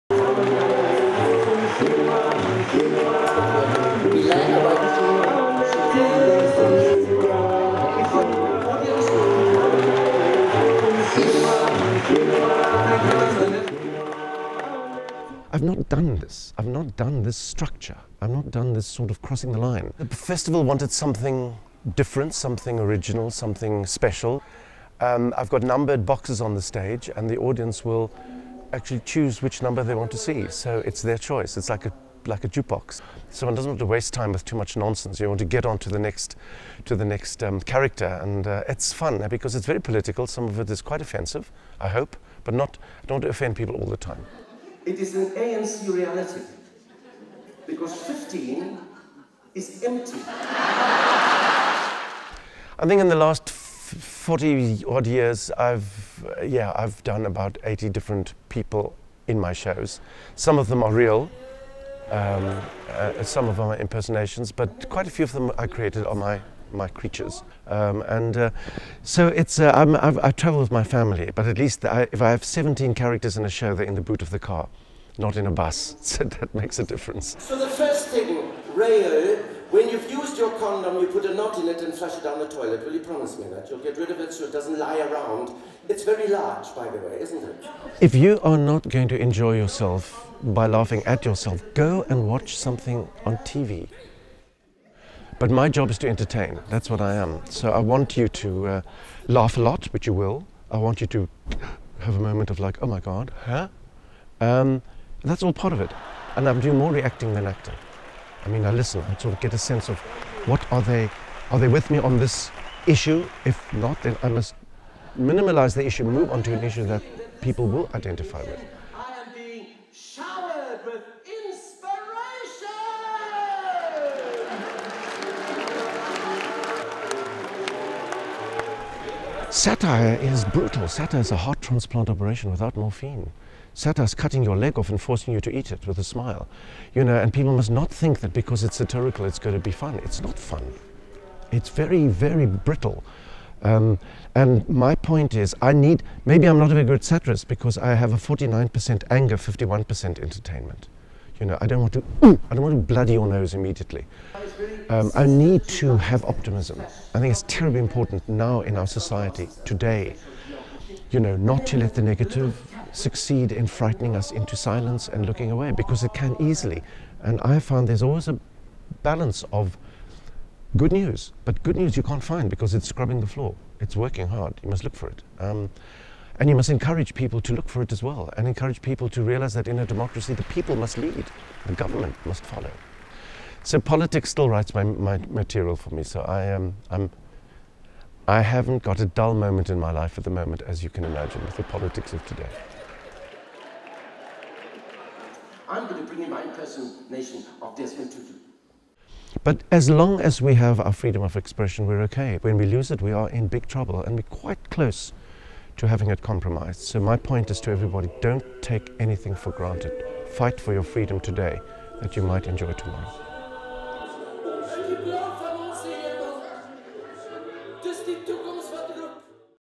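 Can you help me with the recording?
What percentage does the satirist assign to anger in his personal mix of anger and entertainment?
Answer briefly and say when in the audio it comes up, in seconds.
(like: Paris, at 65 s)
49%, at 148 s.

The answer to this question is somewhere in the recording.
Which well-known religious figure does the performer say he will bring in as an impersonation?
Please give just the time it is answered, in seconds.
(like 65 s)
197 s.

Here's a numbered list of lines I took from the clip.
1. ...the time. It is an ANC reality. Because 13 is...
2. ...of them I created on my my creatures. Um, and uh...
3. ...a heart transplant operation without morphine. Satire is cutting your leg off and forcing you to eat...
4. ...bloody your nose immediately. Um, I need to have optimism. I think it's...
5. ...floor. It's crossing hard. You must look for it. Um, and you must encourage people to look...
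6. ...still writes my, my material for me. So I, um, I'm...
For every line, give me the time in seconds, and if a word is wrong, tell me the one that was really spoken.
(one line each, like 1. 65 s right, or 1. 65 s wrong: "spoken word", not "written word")
1. 43 s wrong: "15", not "13"
2. 65 s right
3. 131 s right
4. 152 s right
5. 173 s wrong: "working", not "crossing"
6. 184 s right.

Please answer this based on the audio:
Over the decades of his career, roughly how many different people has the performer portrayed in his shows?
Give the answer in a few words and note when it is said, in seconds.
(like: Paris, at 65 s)
80, at 57 s.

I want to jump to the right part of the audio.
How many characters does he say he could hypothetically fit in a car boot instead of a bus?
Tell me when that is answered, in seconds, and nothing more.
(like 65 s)
72 s.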